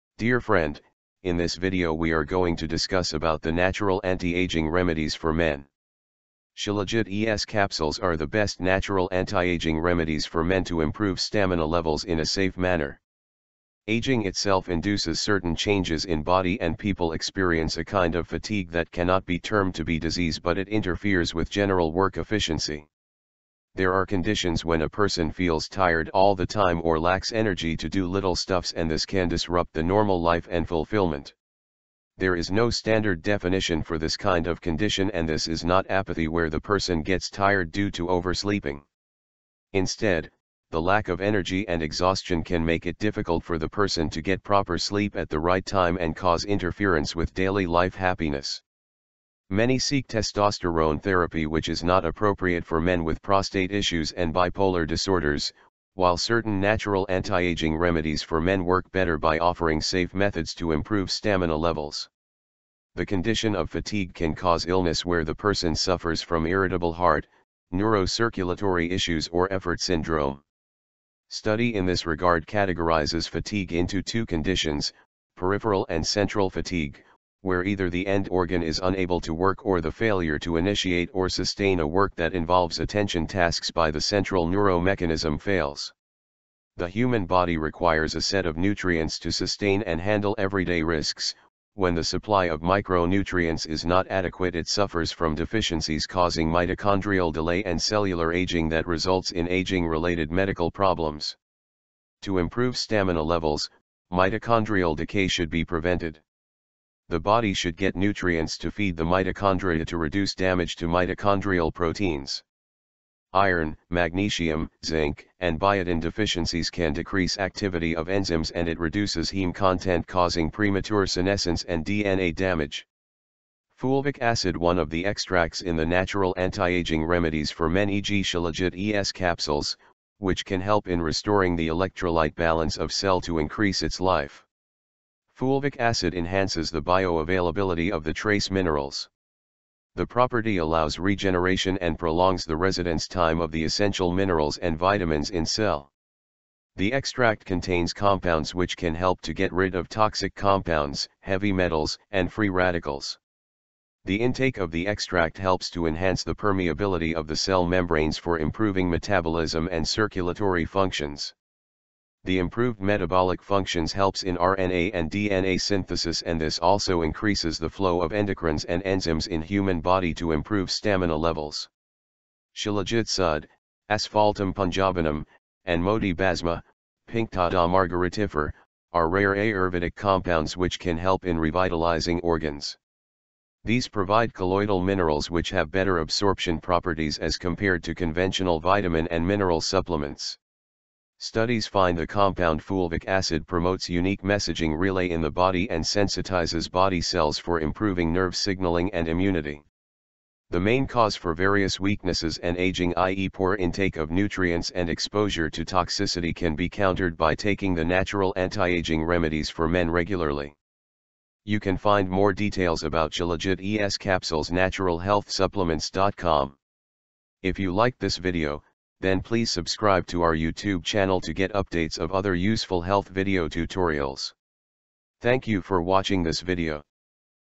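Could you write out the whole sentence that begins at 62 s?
The condition of fatigue can cause illness where the person suffers from irritable heart, neurocirculatory issues or effort syndrome.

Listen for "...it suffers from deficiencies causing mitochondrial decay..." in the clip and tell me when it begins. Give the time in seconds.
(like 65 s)
94 s.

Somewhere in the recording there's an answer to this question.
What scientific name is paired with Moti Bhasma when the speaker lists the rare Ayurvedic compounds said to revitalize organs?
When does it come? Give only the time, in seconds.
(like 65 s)
177 s.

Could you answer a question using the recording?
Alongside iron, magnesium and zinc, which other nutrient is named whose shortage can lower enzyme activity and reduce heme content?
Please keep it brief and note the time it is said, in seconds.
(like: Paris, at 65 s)
Biotin, at 115 s.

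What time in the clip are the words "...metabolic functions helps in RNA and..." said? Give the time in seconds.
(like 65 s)
162 s.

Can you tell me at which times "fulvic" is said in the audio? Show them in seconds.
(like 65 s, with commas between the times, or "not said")
123 s, 135 s, 192 s.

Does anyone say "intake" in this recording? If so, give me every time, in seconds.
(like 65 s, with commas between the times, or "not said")
154 s, 203 s.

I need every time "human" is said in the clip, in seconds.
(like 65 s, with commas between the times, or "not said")
86 s, 169 s.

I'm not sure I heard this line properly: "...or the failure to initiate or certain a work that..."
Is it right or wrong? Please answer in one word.
wrong.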